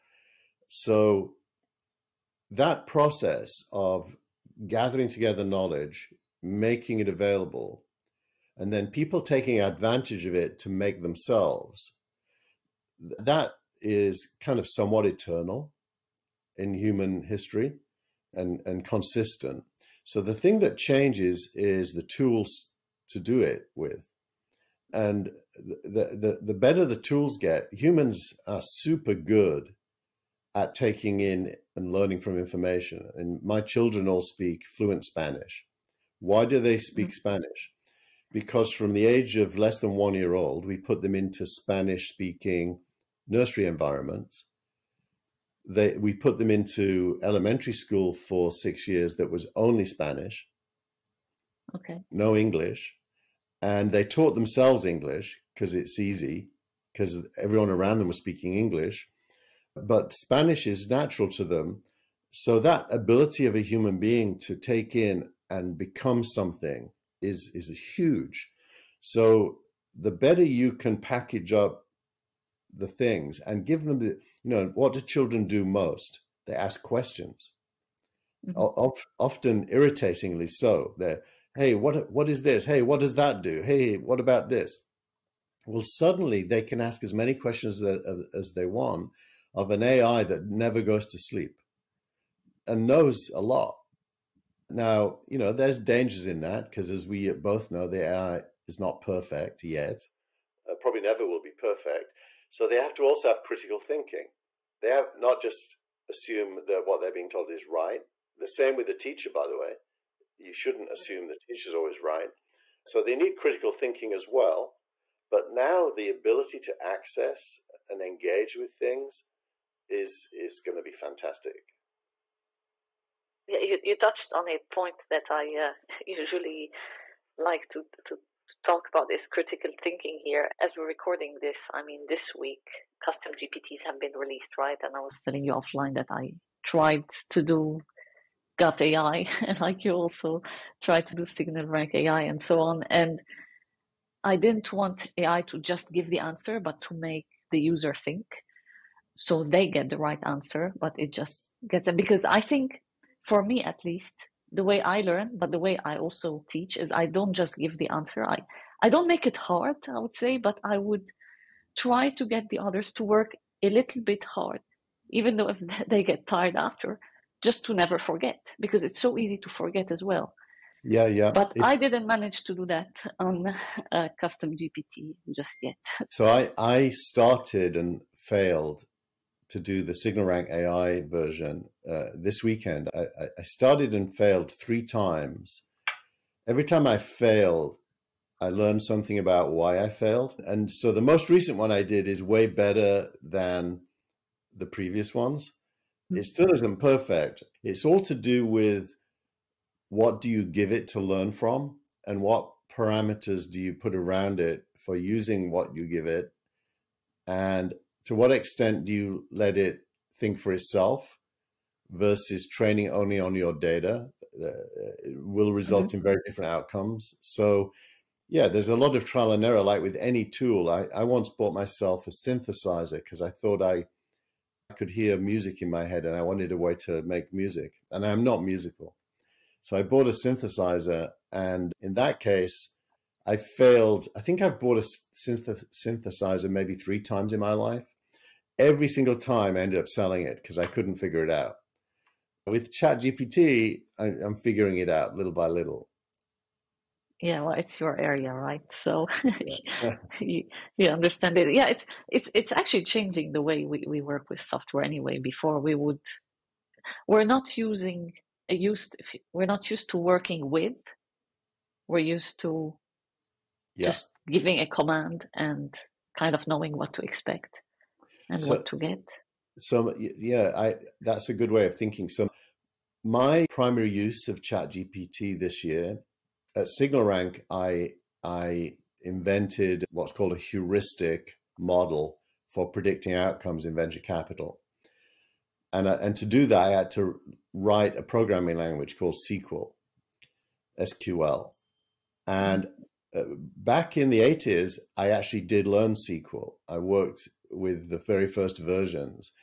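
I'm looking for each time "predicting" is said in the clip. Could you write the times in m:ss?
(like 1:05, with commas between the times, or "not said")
4:42.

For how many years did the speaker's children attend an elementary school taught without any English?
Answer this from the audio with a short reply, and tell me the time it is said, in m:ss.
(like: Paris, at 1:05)
6, at 0:48.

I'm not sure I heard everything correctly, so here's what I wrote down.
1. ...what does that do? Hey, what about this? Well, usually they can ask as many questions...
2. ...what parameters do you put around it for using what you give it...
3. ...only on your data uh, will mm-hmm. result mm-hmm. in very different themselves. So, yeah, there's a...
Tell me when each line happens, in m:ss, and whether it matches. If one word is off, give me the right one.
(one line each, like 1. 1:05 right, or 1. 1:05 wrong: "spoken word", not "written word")
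1. 1:22 wrong: "suddenly", not "usually"
2. 3:22 right
3. 3:32 wrong: "outcomes", not "themselves".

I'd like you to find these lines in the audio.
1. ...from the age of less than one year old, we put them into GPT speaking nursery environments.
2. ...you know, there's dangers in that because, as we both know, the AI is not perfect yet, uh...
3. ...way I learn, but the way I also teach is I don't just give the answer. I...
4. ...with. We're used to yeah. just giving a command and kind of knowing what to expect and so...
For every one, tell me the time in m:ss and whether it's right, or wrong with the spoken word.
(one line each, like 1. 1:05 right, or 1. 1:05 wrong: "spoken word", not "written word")
1. 0:38 wrong: "Spanish", not "GPT"
2. 1:35 right
3. 2:34 right
4. 4:20 right.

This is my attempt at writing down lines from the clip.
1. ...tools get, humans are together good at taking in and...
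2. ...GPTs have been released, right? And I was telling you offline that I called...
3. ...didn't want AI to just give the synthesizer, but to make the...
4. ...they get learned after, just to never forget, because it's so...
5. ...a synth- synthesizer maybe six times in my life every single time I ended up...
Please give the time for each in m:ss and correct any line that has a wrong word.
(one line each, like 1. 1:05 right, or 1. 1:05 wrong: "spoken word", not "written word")
1. 0:26 wrong: "super", not "together"
2. 2:13 wrong: "tried", not "called"
3. 2:24 wrong: "answer", not "synthesizer"
4. 2:45 wrong: "tired", not "learned"
5. 3:54 wrong: "three", not "six".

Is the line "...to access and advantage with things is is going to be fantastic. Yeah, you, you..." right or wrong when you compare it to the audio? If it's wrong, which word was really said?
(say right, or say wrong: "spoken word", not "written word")
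wrong: "engage", not "advantage".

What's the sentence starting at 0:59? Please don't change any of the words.
But Spanish is natural to them.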